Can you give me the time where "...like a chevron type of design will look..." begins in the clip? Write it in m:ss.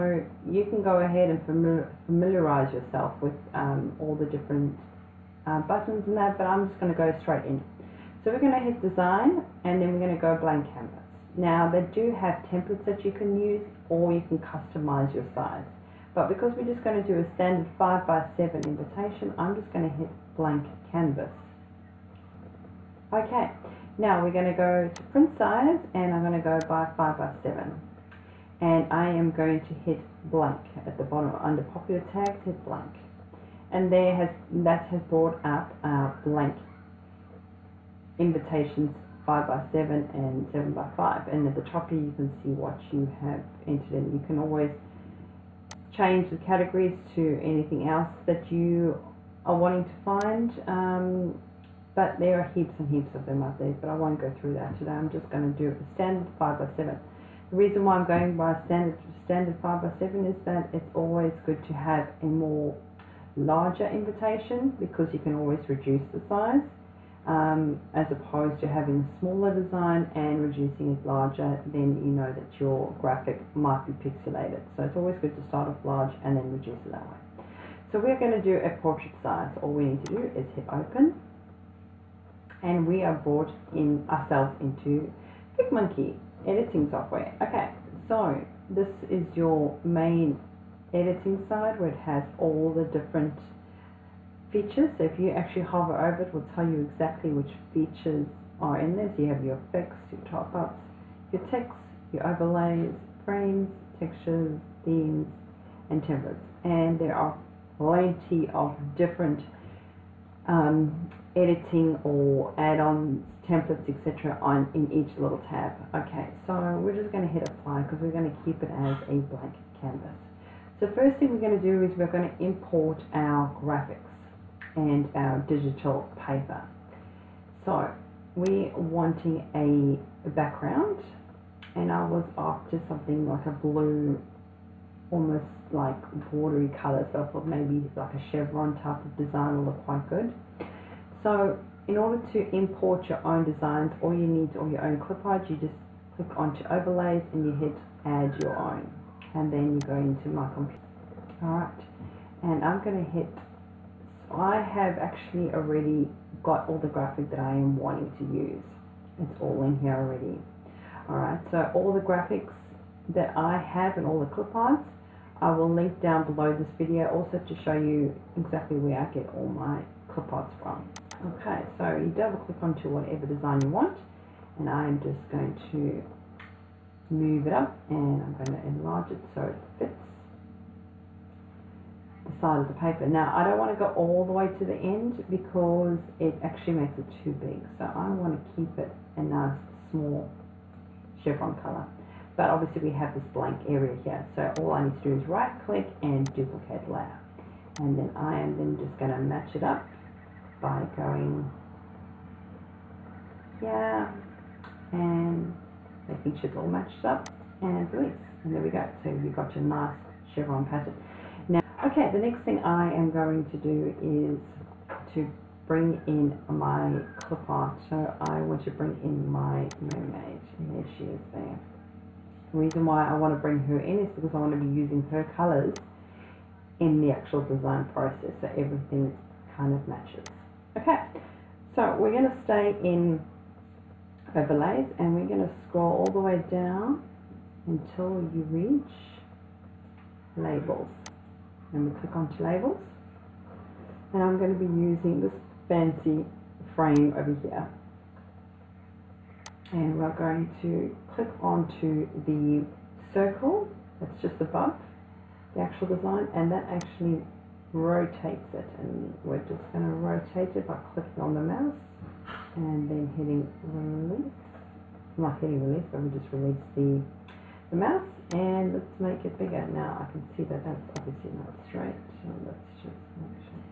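2:17.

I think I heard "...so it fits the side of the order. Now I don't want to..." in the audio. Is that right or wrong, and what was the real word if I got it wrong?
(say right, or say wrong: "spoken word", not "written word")
wrong: "paper", not "order".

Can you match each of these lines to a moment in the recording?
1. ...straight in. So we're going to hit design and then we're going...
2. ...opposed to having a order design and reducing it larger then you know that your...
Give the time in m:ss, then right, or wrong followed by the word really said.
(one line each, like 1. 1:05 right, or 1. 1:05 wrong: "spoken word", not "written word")
1. 0:07 right
2. 1:08 wrong: "smaller", not "order".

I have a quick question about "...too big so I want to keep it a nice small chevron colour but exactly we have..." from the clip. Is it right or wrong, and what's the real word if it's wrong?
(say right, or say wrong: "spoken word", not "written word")
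wrong: "obviously", not "exactly".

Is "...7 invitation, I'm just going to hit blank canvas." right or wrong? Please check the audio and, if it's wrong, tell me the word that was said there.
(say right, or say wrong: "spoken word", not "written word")
right.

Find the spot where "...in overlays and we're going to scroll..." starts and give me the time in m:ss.
3:52.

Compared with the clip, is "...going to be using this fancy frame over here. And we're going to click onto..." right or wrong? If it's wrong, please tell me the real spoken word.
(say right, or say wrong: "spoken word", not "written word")
right.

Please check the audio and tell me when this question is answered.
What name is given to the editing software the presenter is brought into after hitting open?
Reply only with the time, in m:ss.
1:25.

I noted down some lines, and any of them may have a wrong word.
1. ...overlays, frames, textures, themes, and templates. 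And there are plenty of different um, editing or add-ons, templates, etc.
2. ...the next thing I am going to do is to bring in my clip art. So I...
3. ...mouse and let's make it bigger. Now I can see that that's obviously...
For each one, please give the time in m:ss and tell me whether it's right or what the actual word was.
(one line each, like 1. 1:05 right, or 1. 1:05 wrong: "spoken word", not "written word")
1. 1:42 right
2. 3:32 right
3. 4:27 right.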